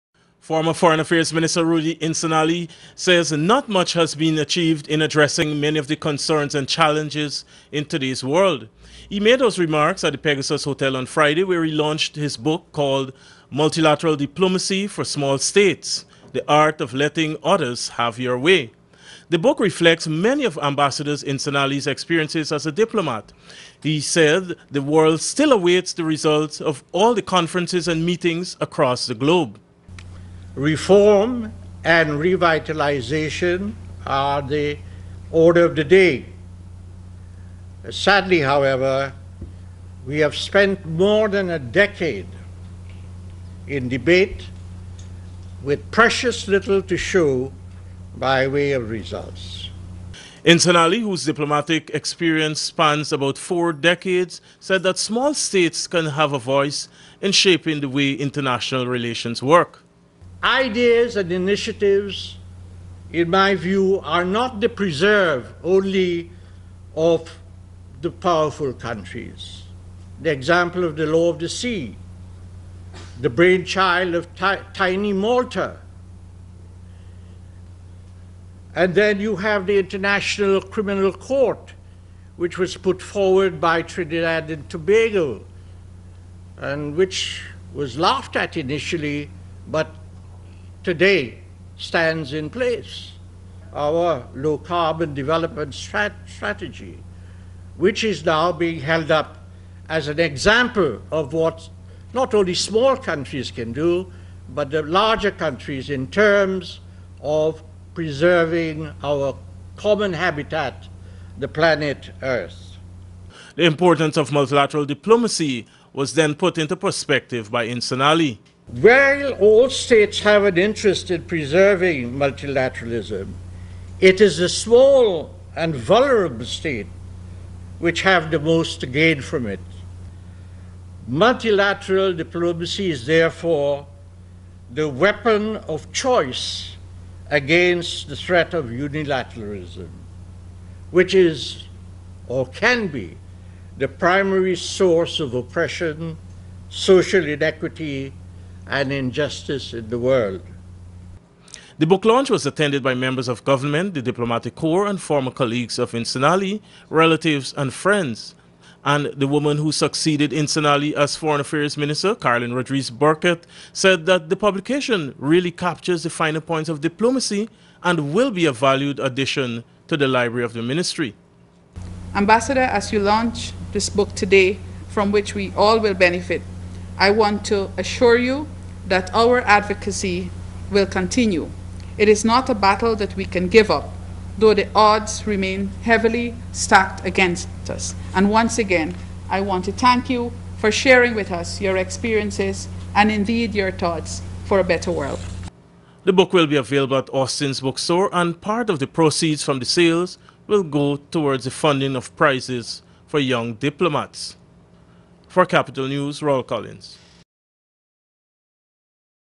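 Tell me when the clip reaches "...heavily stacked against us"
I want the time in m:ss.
3:05.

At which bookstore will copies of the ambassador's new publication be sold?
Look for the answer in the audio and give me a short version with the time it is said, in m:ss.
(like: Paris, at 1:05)
Austin's bookstore, at 3:17.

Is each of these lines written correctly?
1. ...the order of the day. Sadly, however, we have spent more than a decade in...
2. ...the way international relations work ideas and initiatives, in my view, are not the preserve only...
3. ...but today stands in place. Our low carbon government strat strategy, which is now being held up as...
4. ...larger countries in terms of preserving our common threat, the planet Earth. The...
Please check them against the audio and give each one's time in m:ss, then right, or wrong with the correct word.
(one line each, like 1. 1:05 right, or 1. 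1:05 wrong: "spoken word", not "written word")
1. 0:34 right
2. 0:57 right
3. 1:29 wrong: "development", not "government"
4. 1:44 wrong: "habitat", not "threat".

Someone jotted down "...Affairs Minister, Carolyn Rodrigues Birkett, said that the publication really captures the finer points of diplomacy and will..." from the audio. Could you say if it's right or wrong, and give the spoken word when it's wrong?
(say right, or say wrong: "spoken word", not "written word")
right.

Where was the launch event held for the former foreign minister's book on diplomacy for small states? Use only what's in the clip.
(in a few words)
Pegasus Hotel.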